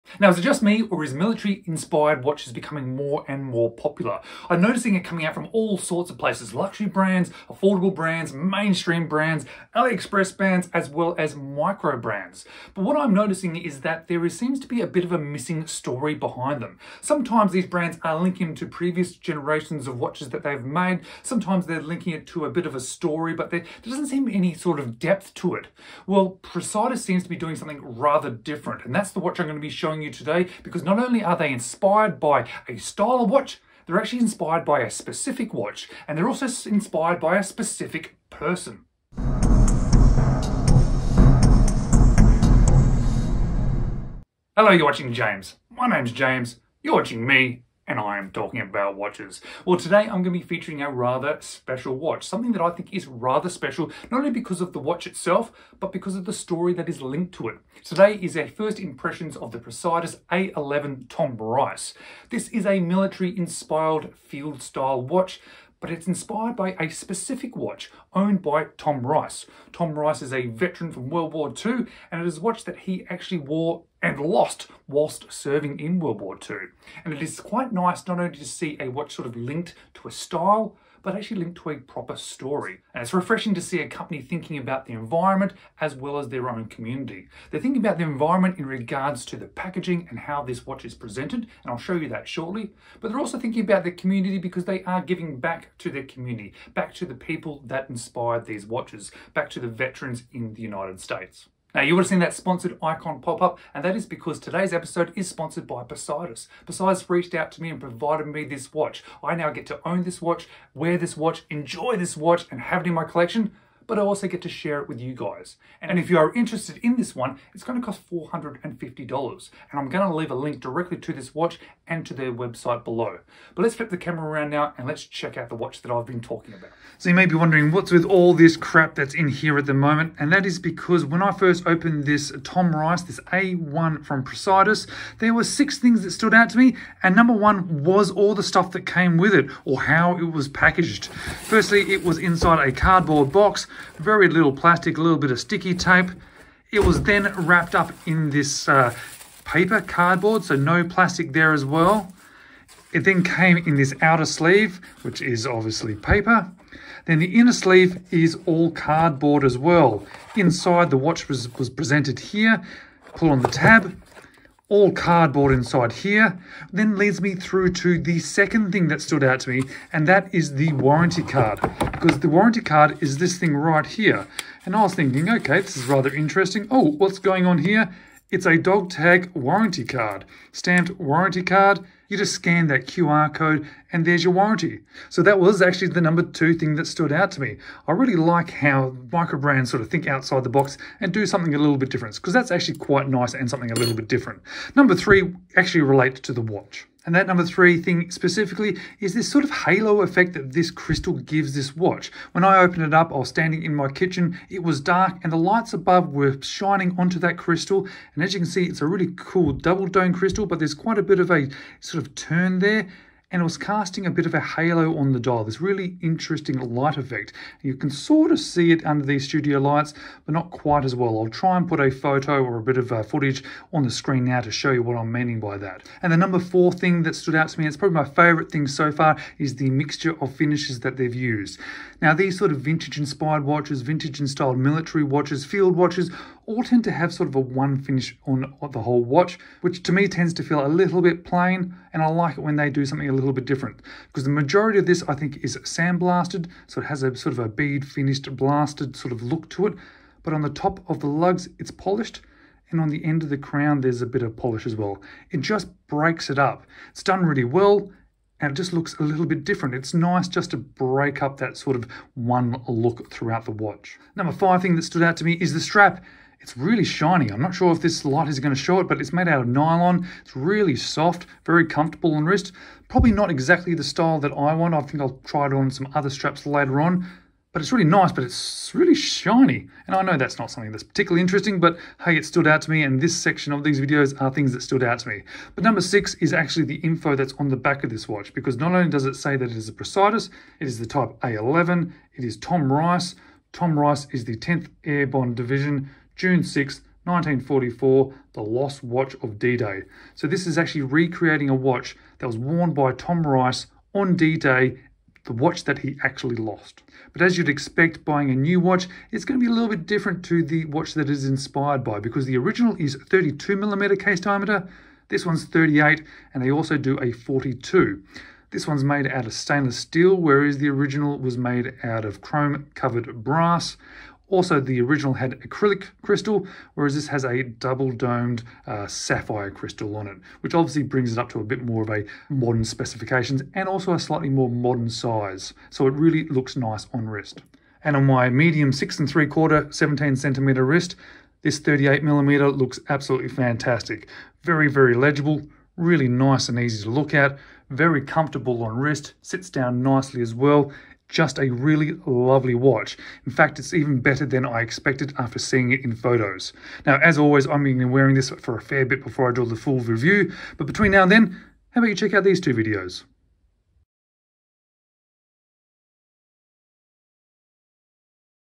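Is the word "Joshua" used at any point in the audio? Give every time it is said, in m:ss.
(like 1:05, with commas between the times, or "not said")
not said.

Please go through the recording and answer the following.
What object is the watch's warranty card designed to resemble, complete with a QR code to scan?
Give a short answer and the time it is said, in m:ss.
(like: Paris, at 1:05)
A dog tag, at 2:58.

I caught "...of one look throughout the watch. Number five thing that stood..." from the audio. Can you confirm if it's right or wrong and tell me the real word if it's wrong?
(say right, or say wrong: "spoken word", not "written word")
right.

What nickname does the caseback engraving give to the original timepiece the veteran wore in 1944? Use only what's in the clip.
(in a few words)
The lost watch of D-Day.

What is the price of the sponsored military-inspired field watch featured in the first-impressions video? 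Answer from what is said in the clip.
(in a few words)
$450.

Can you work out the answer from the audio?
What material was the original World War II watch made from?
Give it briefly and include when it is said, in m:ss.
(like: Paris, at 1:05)
Chrome covered brass, at 5:22.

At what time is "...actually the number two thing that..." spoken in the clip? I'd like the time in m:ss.
3:05.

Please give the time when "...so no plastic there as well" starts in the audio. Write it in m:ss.
2:30.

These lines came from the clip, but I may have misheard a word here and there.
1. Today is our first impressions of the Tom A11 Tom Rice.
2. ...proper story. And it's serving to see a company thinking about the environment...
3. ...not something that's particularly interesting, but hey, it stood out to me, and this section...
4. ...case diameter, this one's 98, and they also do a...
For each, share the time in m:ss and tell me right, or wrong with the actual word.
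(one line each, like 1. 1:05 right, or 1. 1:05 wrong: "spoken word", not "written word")
1. 0:57 wrong: "Praesidus", not "Tom"
2. 1:21 wrong: "refreshing", not "serving"
3. 4:40 right
4. 5:13 wrong: "38", not "98".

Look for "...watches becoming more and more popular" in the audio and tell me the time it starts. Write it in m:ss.
0:02.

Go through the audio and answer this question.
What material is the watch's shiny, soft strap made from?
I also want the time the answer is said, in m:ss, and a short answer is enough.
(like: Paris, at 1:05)
Nylon, at 4:29.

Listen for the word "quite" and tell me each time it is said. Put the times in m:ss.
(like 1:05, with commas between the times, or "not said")
1:17, 3:12, 3:30, 3:40.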